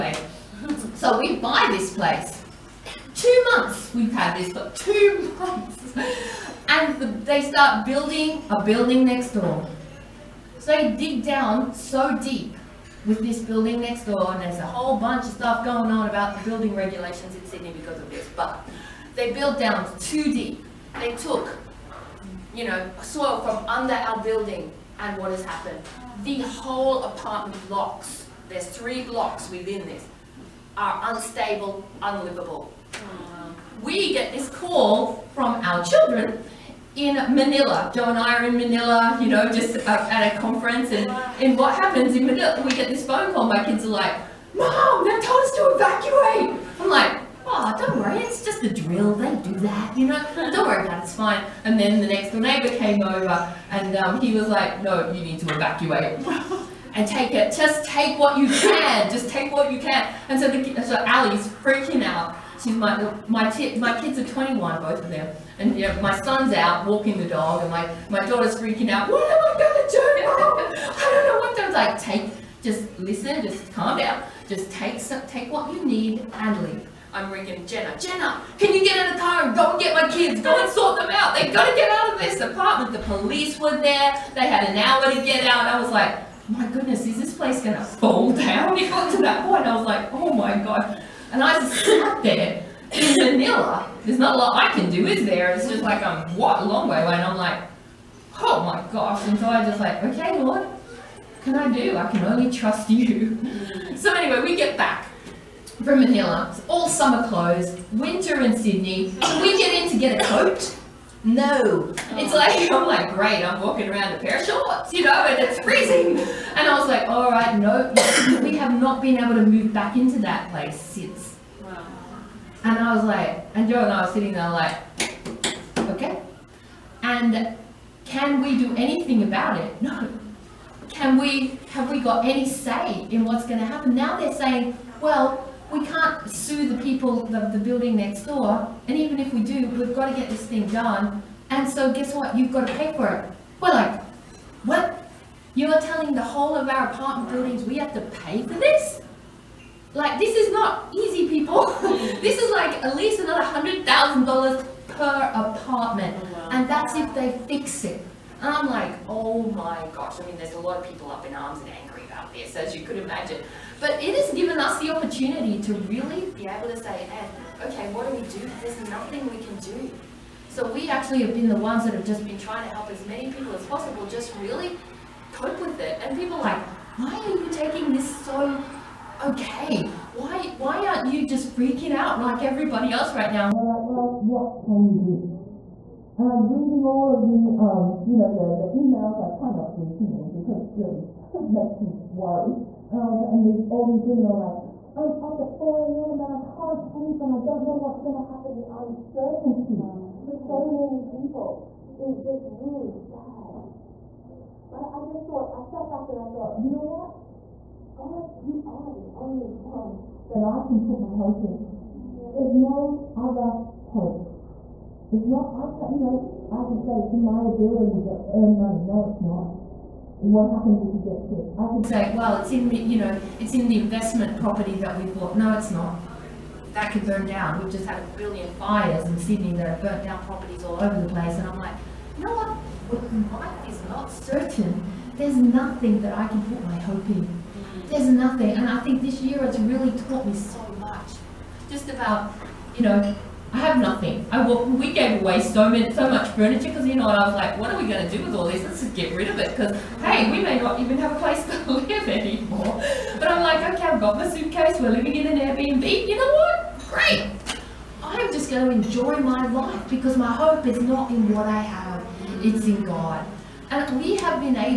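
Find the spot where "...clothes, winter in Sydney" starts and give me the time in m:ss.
1:47.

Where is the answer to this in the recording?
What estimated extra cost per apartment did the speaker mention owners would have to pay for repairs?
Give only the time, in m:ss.
2:33.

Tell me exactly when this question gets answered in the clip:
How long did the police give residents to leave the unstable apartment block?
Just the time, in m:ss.
1:24.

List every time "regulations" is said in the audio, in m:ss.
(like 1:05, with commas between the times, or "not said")
0:16.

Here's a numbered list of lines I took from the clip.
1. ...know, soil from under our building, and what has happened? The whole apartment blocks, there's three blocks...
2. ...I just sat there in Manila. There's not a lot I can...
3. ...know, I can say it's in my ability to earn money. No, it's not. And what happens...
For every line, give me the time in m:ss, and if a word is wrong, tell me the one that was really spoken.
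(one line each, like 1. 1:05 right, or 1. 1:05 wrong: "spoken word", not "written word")
1. 0:22 right
2. 1:31 right
3. 3:35 right.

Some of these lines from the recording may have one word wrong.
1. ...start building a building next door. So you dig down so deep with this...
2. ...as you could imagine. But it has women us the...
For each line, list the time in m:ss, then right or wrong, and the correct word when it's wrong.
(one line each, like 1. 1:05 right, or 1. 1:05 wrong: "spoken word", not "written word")
1. 0:07 right
2. 2:42 wrong: "given", not "women".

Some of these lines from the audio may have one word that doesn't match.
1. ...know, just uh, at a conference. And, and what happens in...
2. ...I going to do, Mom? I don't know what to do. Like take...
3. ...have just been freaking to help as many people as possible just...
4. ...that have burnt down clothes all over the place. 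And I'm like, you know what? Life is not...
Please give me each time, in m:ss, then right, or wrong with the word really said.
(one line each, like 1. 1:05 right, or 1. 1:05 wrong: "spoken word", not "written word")
1. 0:39 right
2. 1:09 right
3. 2:51 wrong: "trying", not "freaking"
4. 3:49 wrong: "properties", not "clothes".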